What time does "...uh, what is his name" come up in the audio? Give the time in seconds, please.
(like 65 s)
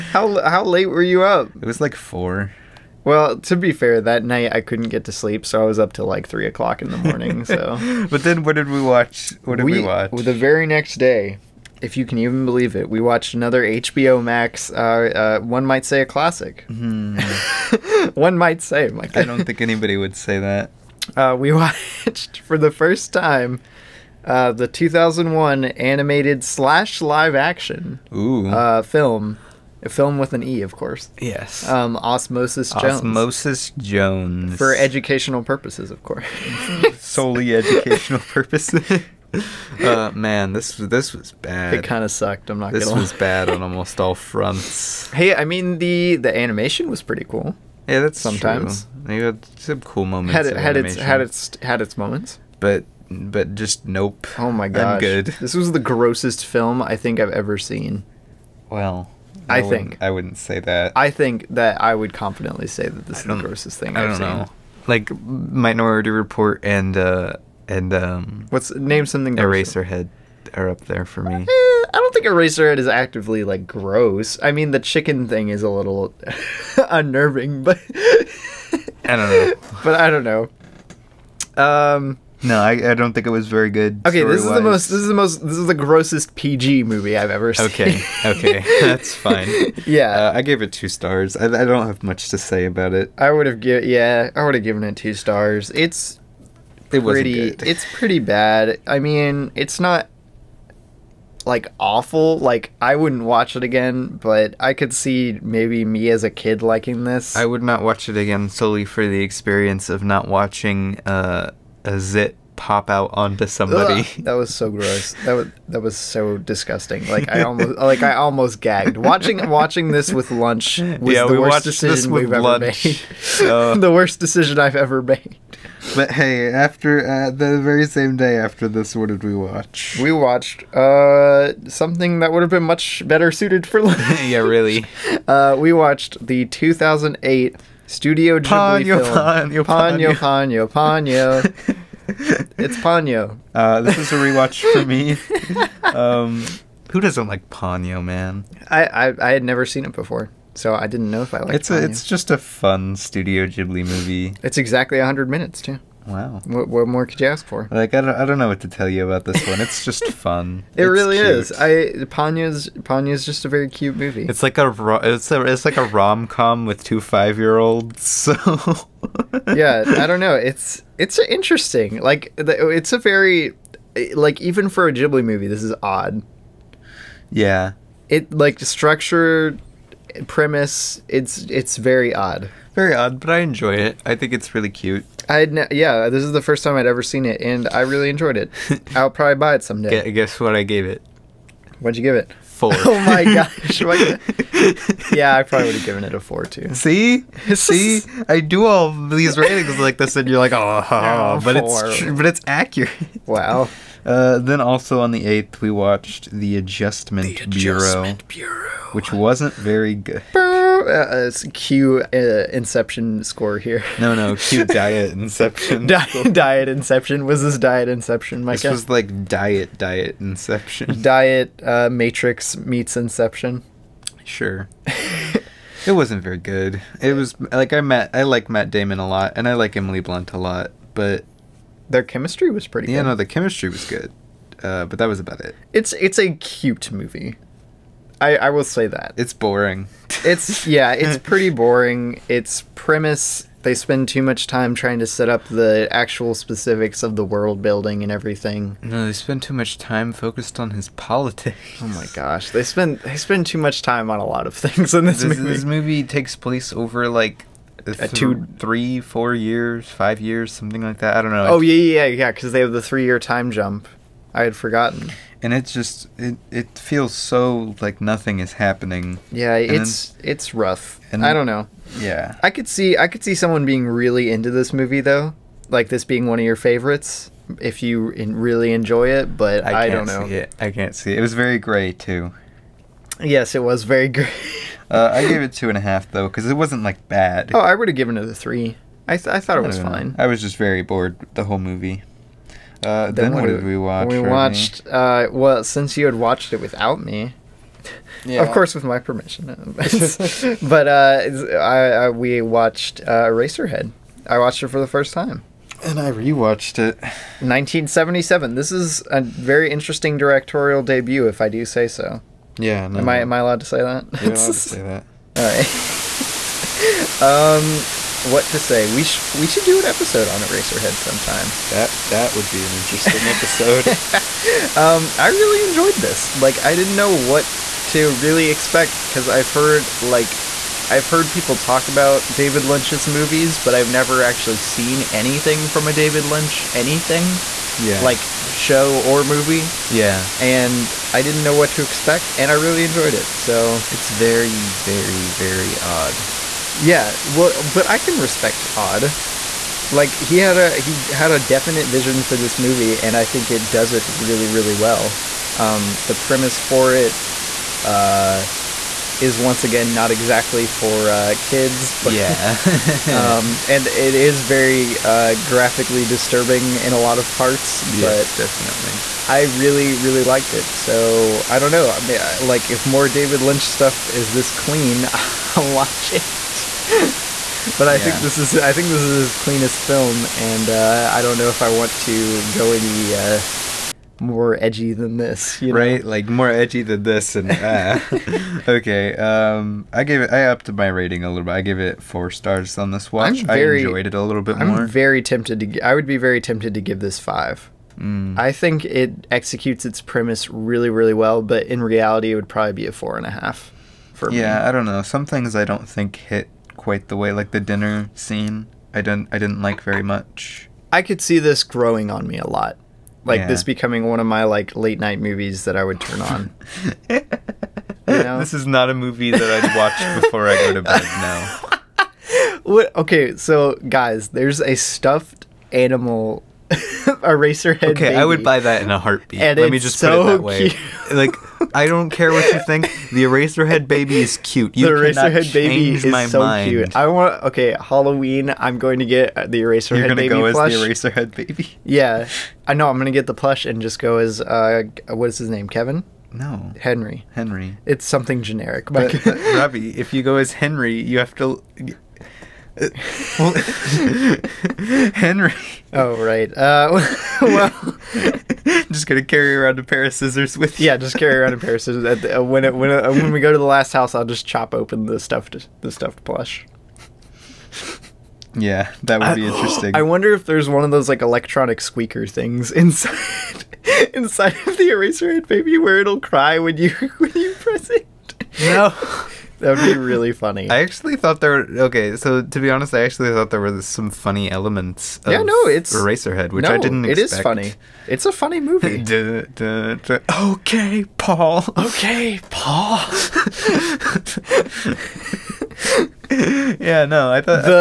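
444 s.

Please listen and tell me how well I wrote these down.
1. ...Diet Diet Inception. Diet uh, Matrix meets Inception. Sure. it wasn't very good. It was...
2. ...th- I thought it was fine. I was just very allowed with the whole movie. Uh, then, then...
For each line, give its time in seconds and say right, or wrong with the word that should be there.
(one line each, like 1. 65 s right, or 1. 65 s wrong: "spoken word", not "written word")
1. 219 s right
2. 289 s wrong: "bored", not "allowed".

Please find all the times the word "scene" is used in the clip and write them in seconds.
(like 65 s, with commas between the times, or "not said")
408 s.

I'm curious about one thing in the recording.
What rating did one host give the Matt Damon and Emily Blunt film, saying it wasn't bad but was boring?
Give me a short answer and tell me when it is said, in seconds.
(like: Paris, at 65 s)
2.5, at 285 s.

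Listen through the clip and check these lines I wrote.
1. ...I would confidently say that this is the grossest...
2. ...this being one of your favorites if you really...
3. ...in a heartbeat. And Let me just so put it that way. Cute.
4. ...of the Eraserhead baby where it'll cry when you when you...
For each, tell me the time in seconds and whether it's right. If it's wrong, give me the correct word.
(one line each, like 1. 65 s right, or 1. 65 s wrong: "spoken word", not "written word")
1. 61 s right
2. 275 s right
3. 428 s right
4. 474 s right.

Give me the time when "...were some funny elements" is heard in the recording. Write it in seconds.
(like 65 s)
483 s.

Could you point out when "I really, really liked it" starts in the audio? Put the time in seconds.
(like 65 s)
369 s.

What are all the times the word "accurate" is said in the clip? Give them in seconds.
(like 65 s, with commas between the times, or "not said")
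202 s.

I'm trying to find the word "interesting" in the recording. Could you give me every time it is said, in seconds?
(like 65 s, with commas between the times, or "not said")
171 s, 309 s, 322 s, 469 s.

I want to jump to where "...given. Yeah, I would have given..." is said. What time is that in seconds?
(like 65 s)
93 s.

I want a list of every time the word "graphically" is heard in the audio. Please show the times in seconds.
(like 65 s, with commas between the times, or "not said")
365 s.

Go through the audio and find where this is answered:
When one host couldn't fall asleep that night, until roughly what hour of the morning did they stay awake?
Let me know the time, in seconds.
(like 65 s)
6 s.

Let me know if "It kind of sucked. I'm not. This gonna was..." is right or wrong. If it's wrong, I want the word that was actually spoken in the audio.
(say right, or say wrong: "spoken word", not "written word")
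right.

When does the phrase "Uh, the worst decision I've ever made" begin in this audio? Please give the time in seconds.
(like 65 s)
123 s.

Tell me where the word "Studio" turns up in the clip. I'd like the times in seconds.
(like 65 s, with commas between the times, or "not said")
137 s, 152 s.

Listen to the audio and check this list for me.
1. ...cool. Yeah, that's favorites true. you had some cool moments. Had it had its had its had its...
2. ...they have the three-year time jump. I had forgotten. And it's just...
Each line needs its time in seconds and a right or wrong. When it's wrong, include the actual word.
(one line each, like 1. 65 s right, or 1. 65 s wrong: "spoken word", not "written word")
1. 47 s wrong: "sometimes", not "favorites"
2. 262 s right.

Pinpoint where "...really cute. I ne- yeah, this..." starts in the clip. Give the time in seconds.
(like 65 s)
184 s.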